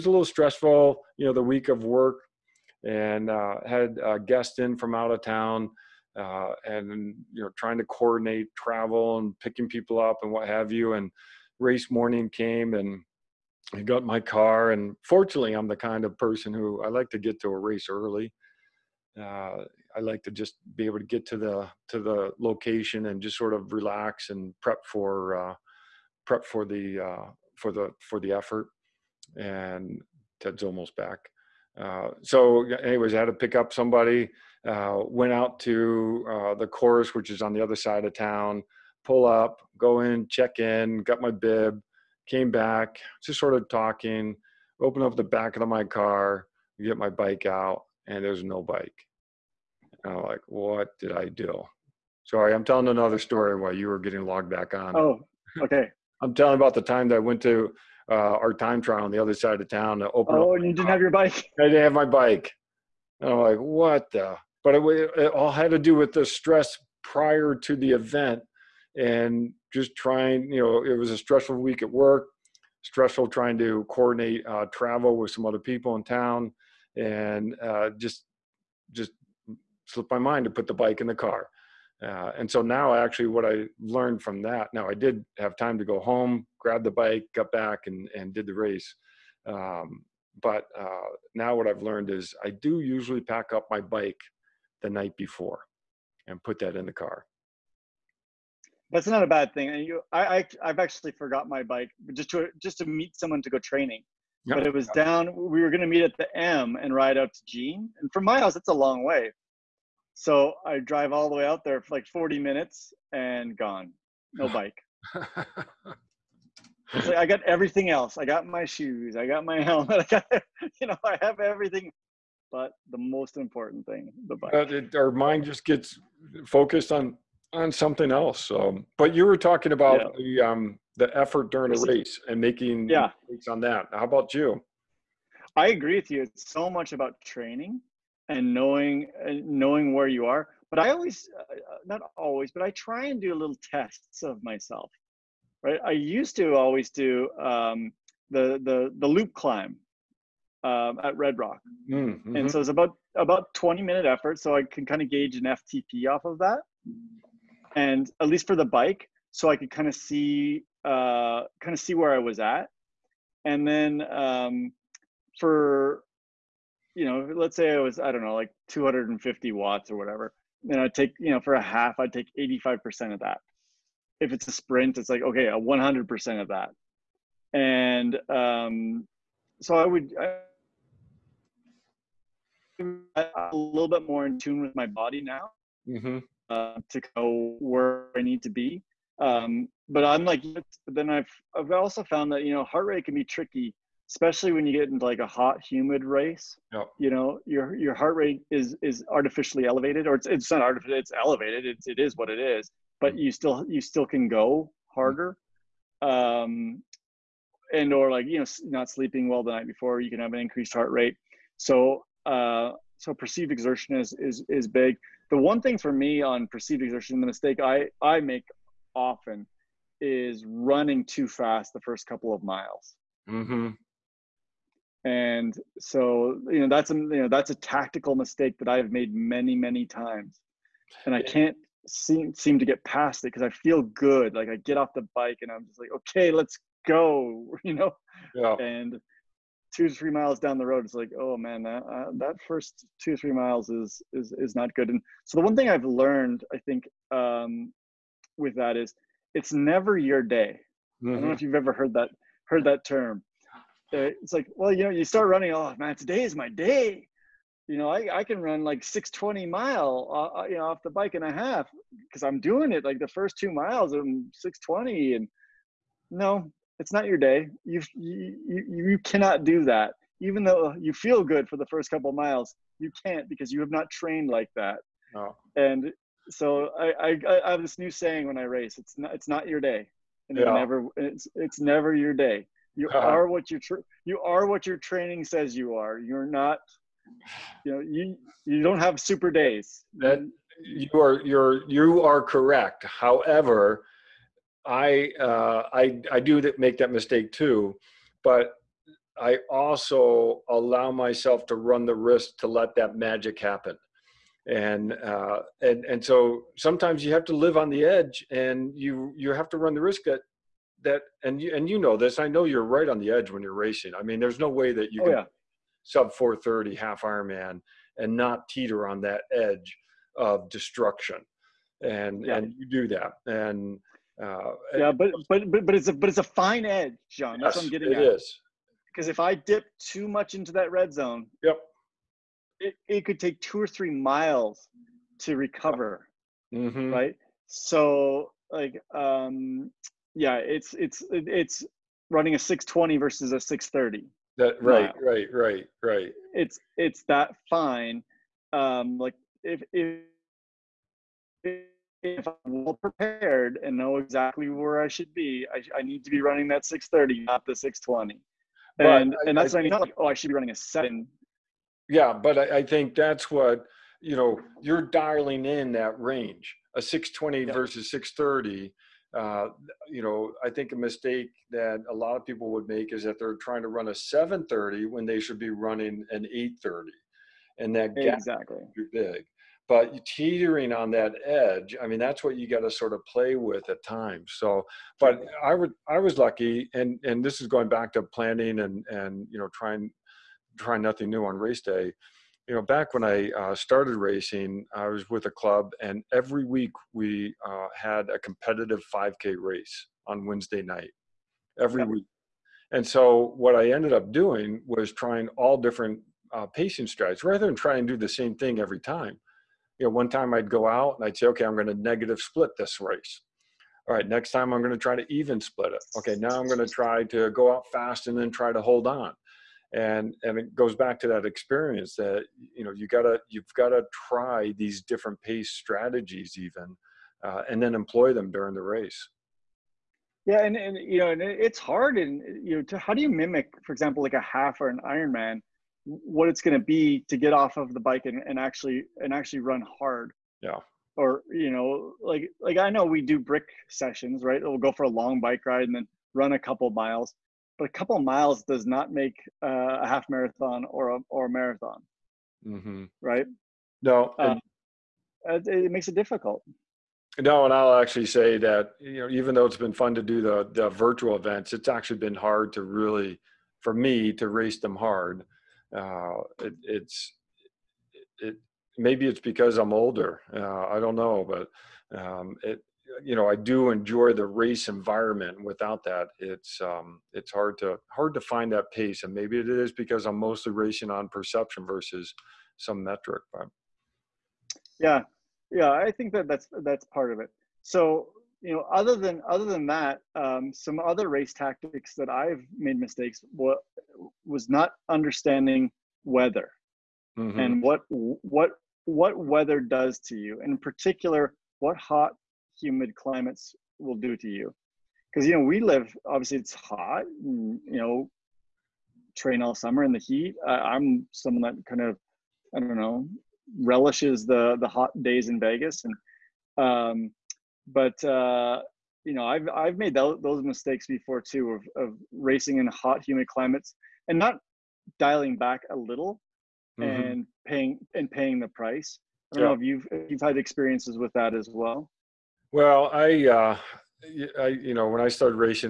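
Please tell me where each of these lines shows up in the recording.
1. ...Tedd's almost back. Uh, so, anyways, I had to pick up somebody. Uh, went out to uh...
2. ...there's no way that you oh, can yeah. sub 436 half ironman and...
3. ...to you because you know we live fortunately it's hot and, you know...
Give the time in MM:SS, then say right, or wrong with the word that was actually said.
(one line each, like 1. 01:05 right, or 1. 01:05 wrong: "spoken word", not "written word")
1. 00:30 right
2. 05:14 wrong: "430", not "436"
3. 08:24 wrong: "obviously", not "fortunately".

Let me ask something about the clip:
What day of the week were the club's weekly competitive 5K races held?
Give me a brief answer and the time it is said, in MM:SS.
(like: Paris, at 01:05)
Wednesday, at 06:40.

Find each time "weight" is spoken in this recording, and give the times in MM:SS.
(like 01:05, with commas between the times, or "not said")
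not said.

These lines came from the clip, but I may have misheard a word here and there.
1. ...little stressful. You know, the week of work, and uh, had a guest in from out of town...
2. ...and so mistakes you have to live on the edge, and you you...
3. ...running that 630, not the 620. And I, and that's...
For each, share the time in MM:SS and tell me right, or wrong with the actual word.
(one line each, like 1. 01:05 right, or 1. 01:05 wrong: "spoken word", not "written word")
1. 00:00 right
2. 05:05 wrong: "sometimes", not "mistakes"
3. 05:56 right.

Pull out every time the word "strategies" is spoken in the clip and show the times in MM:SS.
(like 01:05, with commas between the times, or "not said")
06:46, 07:05.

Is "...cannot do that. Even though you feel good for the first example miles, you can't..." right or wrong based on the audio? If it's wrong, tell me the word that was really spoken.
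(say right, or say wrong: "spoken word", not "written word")
wrong: "couple", not "example".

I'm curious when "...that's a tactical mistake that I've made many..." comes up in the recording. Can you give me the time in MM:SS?
03:47.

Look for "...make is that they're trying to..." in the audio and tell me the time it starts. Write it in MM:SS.
06:12.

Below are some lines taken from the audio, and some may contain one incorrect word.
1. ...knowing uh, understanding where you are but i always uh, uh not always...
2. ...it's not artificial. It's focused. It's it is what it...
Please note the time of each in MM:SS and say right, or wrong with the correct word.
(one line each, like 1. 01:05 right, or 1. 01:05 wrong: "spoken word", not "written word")
1. 02:18 wrong: "knowing", not "understanding"
2. 03:20 wrong: "elevated", not "focused".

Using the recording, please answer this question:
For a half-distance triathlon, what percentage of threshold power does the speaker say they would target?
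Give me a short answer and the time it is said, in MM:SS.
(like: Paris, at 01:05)
85%, at 02:52.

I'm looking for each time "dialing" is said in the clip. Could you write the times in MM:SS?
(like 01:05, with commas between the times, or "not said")
06:04, 08:44.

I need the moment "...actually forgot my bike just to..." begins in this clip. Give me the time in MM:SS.
01:40.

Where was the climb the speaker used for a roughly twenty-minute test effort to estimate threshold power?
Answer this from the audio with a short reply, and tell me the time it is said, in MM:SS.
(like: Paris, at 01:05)
Red Rock, at 02:31.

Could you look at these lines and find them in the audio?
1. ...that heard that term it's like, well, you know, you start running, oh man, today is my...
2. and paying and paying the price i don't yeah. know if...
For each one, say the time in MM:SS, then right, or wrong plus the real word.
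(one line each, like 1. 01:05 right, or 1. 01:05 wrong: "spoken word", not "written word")
1. 04:11 right
2. 08:46 right.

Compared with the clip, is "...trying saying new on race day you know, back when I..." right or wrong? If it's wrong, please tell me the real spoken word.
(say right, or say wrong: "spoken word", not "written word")
wrong: "nothing", not "saying".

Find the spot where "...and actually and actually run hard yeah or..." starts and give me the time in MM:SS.
07:18.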